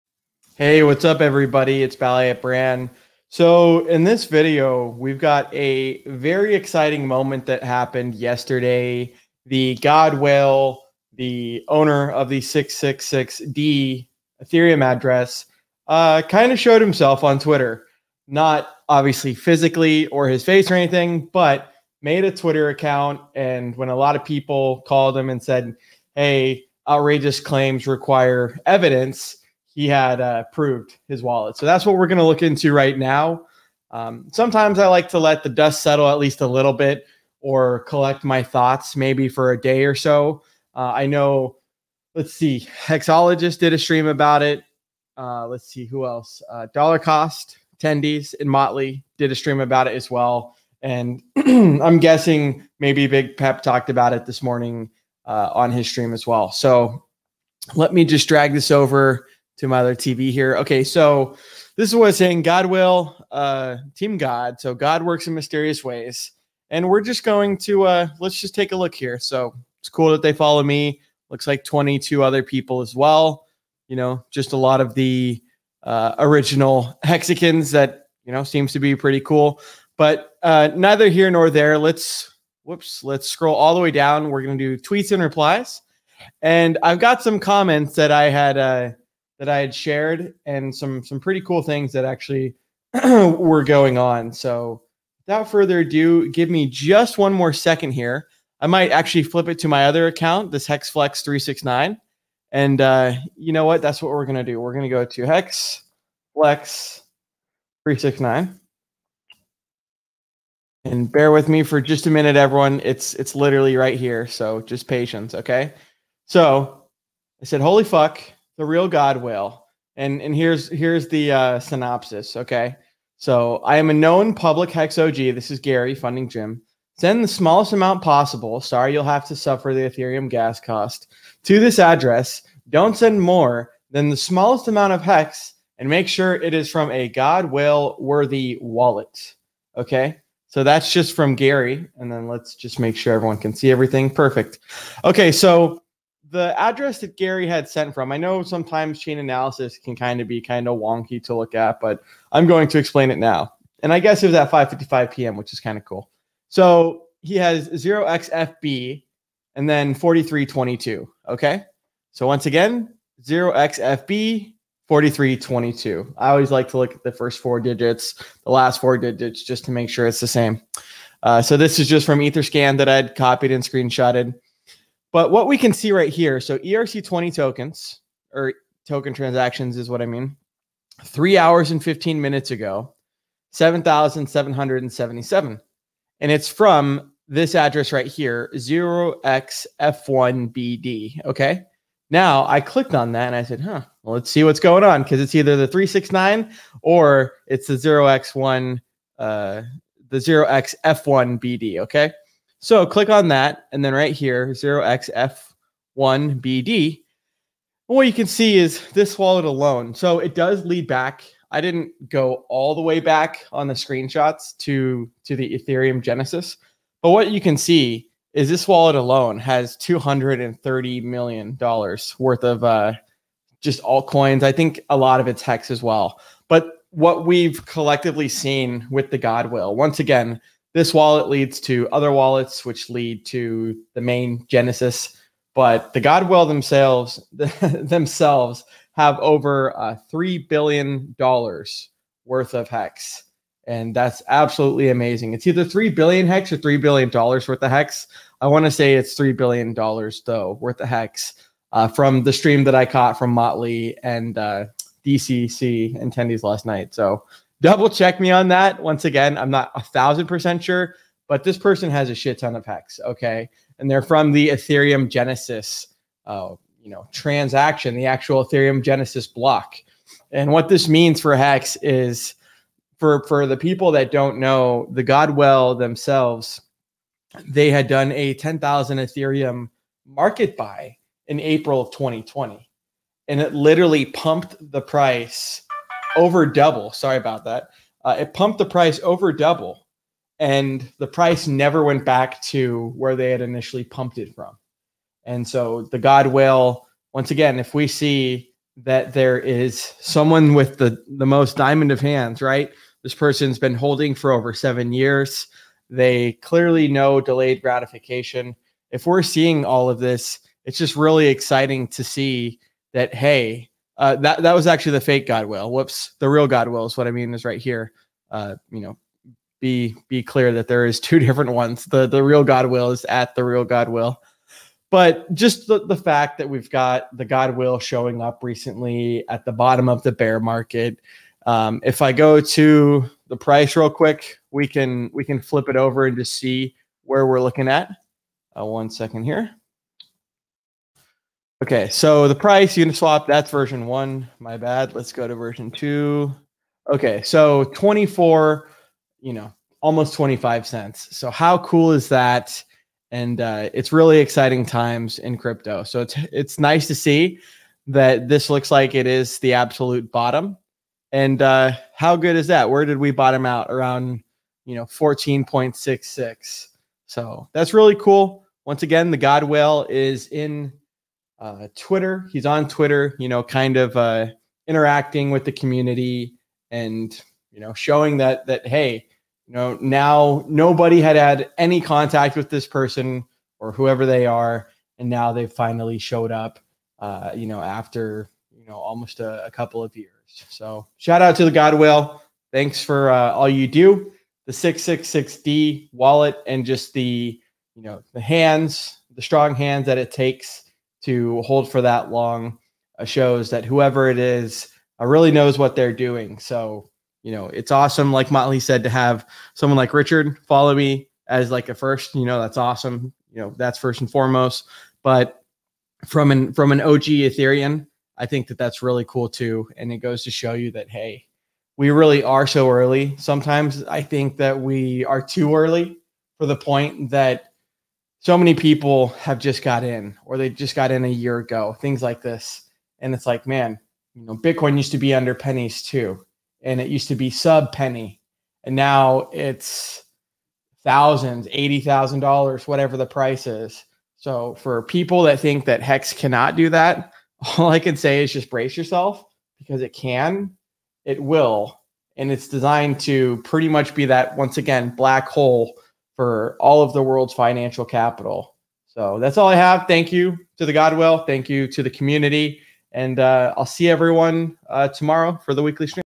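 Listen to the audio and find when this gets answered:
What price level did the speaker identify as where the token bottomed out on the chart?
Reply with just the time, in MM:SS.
06:04.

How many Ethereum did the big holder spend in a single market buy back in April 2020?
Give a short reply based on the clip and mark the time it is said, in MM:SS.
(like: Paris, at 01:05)
10,000, at 04:38.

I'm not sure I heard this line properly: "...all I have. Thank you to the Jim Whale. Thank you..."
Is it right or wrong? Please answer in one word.
wrong.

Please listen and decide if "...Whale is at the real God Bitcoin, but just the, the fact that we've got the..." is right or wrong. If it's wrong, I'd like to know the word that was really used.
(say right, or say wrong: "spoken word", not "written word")
wrong: "Whale", not "Bitcoin".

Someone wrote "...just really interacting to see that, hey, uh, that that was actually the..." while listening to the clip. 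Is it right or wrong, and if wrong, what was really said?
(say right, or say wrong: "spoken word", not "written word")
wrong: "exciting", not "interacting".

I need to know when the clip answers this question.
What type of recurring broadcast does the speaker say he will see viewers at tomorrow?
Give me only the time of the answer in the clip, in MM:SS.
07:45.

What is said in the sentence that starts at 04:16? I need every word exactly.
So double check me on that.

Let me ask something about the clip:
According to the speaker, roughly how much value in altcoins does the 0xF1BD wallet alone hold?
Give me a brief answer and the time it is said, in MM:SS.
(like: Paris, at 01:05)
$230 million, at 03:39.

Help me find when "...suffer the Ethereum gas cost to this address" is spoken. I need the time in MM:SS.
02:09.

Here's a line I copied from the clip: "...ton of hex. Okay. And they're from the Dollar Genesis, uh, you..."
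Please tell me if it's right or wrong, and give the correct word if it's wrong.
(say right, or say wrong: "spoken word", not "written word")
wrong: "Ethereum", not "Dollar".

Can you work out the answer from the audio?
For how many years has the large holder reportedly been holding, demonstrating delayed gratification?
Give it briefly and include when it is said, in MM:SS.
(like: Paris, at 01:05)
Over seven years, at 05:04.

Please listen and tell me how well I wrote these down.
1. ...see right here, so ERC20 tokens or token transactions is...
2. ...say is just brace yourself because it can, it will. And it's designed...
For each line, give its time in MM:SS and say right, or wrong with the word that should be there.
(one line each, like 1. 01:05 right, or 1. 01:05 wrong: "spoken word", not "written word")
1. 02:55 right
2. 07:27 right.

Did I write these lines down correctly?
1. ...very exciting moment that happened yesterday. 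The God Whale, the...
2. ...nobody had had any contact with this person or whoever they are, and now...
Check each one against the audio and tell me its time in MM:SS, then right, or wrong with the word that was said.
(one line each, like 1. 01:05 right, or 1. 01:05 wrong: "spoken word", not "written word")
1. 00:06 right
2. 06:20 right.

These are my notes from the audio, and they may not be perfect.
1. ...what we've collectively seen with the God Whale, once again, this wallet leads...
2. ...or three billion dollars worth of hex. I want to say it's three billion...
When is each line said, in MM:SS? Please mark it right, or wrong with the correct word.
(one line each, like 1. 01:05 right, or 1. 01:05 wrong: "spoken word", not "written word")
1. 03:46 right
2. 04:06 right.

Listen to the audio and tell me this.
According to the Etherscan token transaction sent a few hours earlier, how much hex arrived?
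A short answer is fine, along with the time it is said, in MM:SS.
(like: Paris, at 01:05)
7,777, at 03:03.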